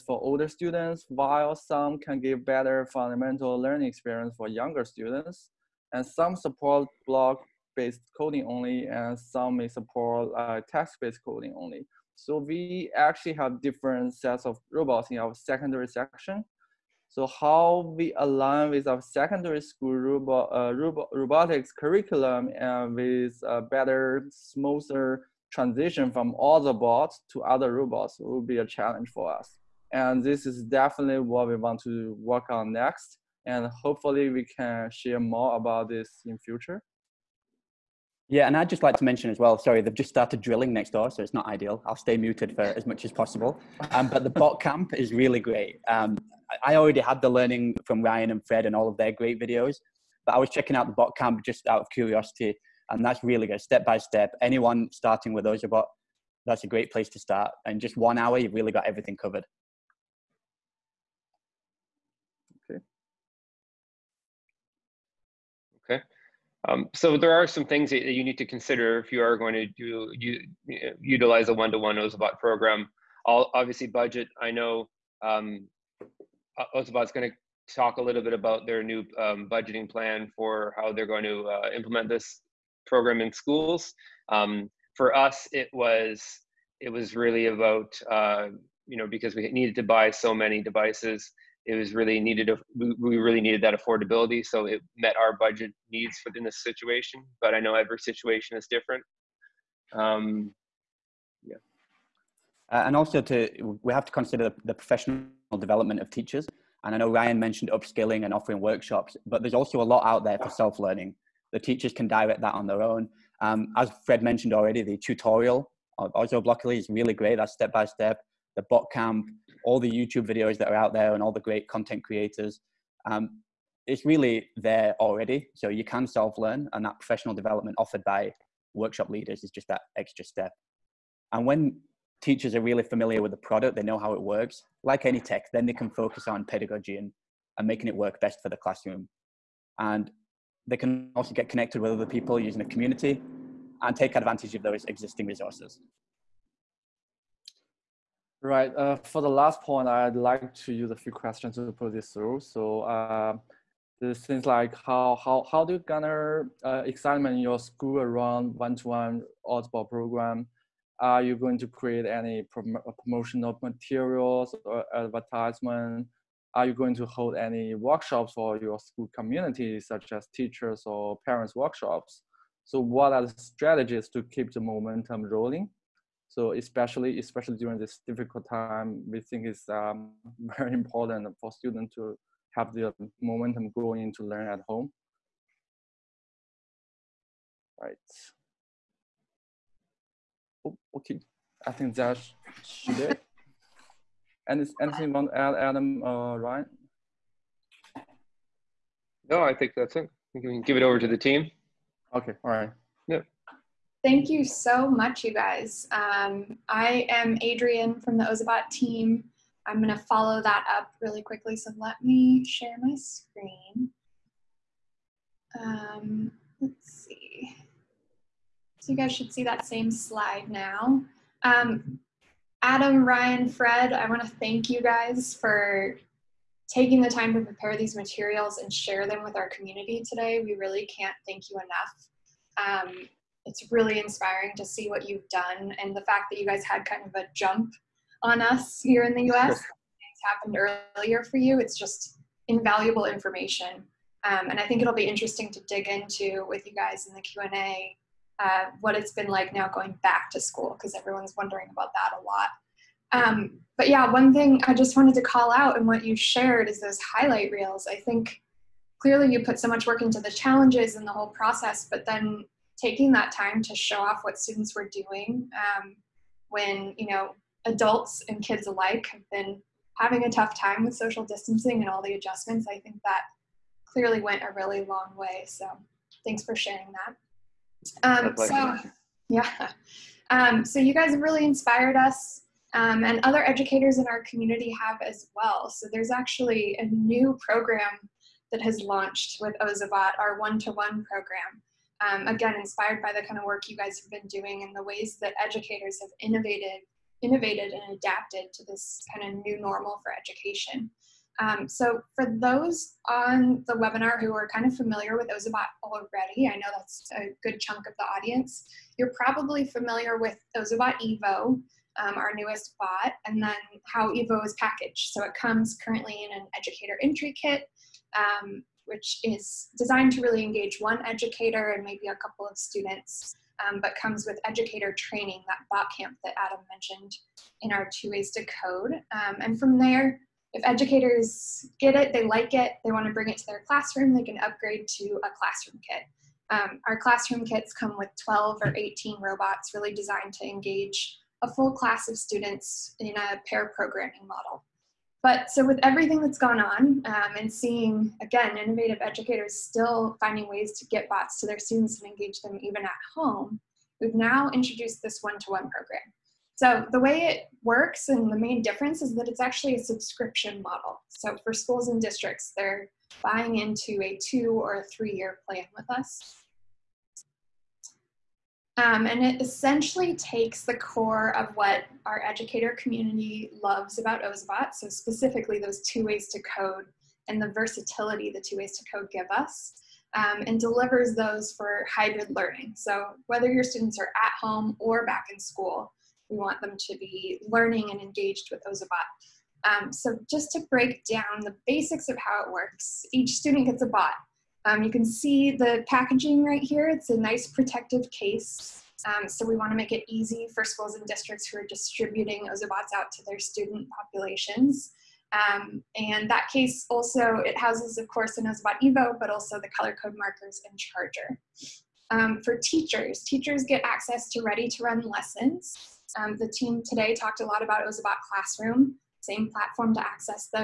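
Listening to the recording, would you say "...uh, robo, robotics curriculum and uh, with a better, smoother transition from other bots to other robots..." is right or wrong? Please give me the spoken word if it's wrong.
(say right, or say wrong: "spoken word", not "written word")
right.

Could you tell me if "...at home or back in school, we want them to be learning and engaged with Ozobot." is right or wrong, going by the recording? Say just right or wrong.
right.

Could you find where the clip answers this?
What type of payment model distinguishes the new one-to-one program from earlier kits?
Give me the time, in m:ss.
5:59.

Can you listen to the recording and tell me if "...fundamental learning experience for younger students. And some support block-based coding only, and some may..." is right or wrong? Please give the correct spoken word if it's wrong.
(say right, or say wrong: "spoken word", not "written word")
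right.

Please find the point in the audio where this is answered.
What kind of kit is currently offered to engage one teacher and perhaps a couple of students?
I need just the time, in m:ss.
5:16.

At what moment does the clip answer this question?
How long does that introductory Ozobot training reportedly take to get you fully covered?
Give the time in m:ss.
0:57.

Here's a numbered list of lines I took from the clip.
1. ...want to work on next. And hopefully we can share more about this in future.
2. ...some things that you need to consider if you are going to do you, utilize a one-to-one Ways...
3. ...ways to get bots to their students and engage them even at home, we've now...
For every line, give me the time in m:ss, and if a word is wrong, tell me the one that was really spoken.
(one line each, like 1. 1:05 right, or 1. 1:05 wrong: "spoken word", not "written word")
1. 0:31 right
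2. 1:07 wrong: "Ozobot", not "Ways"
3. 5:50 right.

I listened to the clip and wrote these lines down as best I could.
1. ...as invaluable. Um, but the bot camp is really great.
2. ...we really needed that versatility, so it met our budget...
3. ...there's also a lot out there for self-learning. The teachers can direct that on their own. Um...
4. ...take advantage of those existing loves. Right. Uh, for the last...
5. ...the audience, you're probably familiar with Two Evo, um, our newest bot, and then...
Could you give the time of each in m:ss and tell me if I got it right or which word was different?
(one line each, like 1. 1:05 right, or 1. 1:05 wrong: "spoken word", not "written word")
1. 0:43 wrong: "possible", not "invaluable"
2. 1:32 wrong: "affordability", not "versatility"
3. 1:49 right
4. 2:23 wrong: "resources", not "loves"
5. 5:07 wrong: "Ozobot", not "Two".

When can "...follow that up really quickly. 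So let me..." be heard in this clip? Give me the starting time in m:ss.
3:30.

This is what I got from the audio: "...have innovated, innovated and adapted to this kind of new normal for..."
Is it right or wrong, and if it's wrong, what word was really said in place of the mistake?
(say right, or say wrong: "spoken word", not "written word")
right.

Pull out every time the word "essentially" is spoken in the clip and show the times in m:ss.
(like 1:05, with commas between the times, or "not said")
6:09.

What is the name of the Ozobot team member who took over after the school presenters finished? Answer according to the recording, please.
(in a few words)
Adrian.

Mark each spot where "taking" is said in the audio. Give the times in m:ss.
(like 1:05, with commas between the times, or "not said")
3:46, 4:22.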